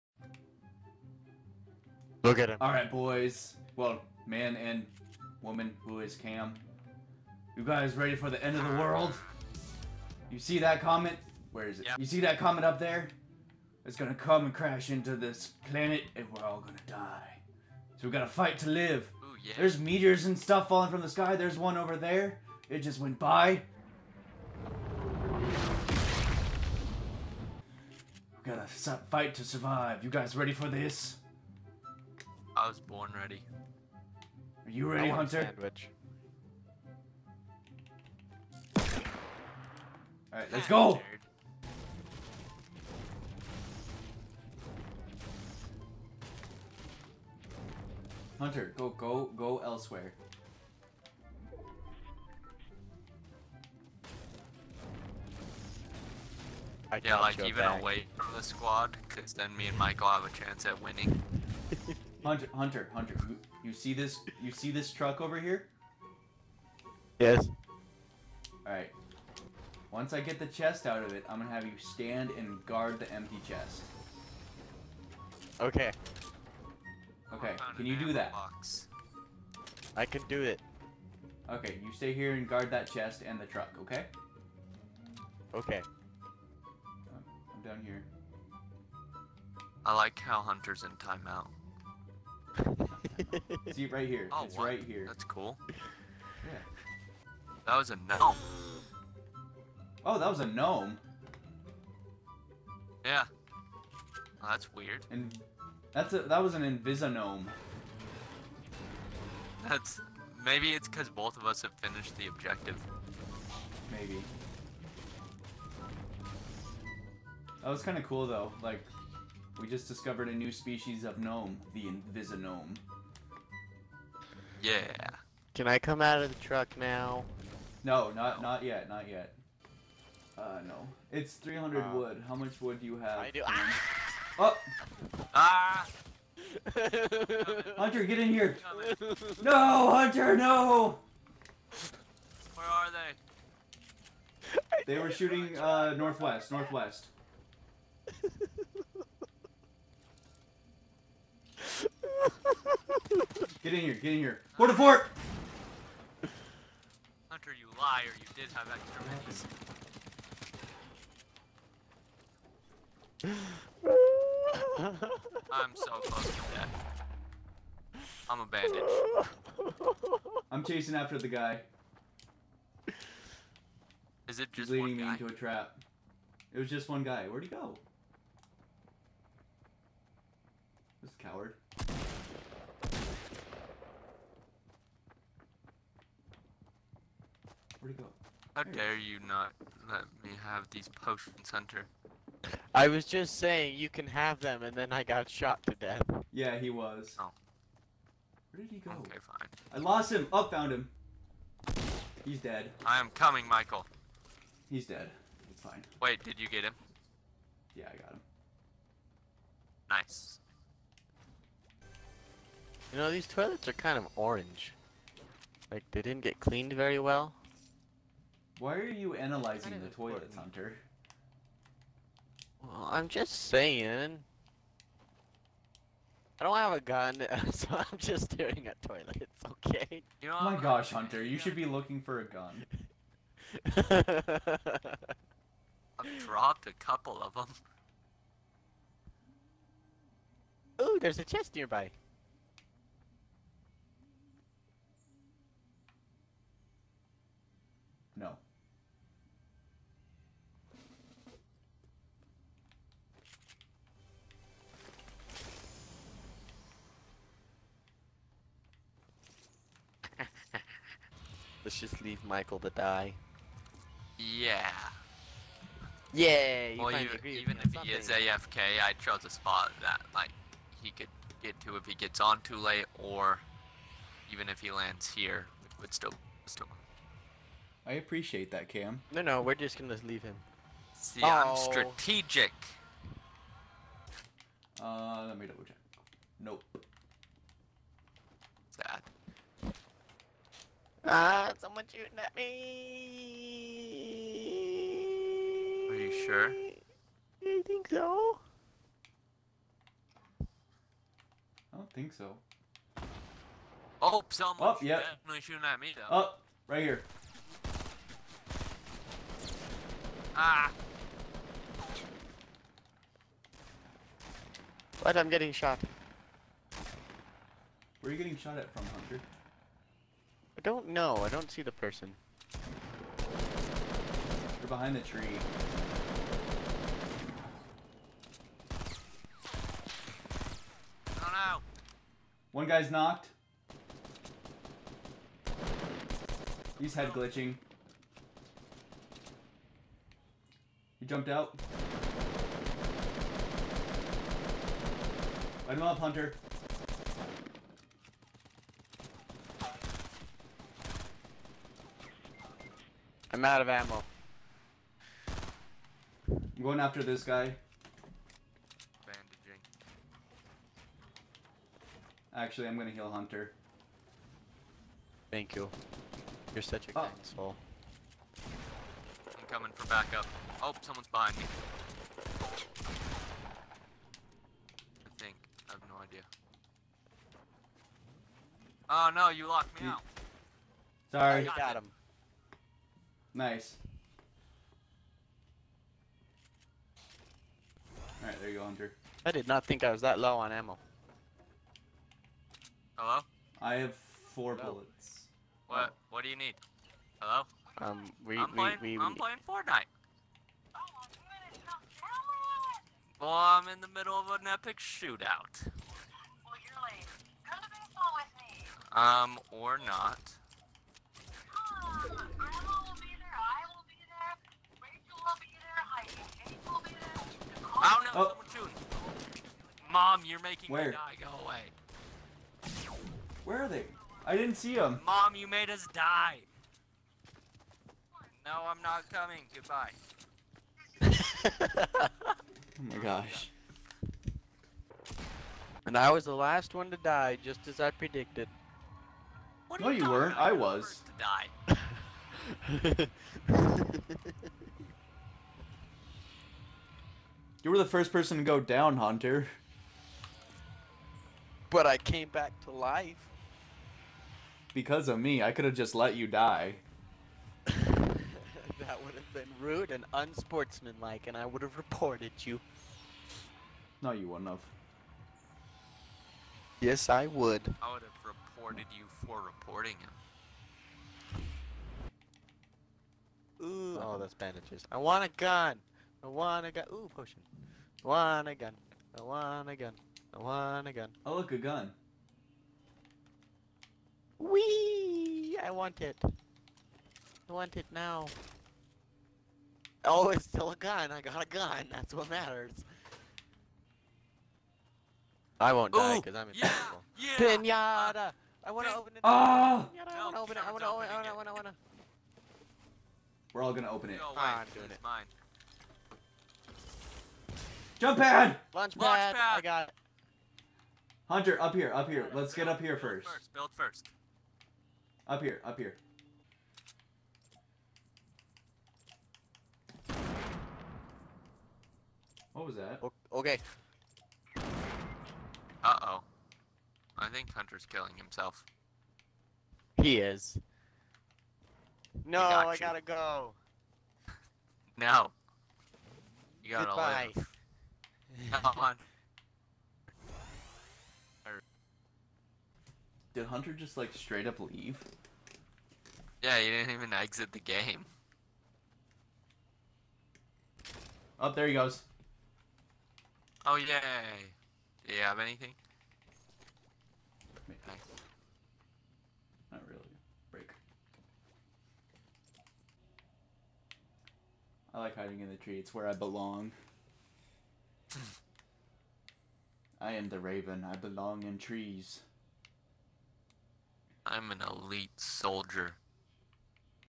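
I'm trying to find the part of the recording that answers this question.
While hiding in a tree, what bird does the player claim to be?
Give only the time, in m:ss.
9:30.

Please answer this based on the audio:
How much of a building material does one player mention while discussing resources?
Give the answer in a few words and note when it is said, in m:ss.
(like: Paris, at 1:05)
300, at 2:11.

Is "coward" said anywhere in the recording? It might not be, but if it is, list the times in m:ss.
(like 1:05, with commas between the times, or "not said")
3:01.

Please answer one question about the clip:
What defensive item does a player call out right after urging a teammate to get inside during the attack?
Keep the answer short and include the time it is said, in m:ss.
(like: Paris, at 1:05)
Port-a-Fort, at 2:34.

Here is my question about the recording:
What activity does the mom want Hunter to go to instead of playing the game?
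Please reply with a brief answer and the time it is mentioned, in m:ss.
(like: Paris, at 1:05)
Baseball, at 6:47.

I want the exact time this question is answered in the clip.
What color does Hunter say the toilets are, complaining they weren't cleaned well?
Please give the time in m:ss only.
3:34.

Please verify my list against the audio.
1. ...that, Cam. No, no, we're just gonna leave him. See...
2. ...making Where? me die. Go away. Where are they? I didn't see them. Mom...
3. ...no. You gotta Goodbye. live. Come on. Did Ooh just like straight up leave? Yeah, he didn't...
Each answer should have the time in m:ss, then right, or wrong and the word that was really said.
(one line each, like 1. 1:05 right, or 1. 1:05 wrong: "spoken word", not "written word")
1. 4:38 right
2. 7:00 right
3. 8:54 wrong: "Hunter", not "Ooh".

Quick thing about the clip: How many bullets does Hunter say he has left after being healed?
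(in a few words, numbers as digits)
4.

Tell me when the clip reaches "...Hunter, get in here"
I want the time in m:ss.
2:17.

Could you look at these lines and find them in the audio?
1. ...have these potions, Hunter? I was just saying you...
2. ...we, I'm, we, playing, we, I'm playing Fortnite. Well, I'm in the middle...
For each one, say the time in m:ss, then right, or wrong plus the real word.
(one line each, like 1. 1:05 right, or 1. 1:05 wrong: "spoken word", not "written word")
1. 3:10 right
2. 6:38 right.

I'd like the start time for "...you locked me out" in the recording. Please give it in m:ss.
6:19.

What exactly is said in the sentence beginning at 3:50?
You know, oh my gosh, Hunter, you should be looking for a gun.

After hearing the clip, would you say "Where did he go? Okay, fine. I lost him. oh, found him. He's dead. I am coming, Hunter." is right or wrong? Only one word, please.
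wrong.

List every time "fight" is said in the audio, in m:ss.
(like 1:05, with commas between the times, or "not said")
0:18, 0:28.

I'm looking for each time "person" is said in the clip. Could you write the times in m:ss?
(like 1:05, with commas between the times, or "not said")
5:21, 7:28.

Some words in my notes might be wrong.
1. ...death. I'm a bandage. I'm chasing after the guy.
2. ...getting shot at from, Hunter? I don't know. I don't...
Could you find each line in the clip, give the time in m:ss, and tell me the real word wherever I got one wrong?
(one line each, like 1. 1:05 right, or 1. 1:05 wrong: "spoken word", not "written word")
1. 2:46 right
2. 5:18 right.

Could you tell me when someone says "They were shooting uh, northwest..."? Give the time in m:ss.
2:24.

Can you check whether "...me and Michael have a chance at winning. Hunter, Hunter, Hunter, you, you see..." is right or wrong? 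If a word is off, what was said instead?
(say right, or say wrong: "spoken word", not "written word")
right.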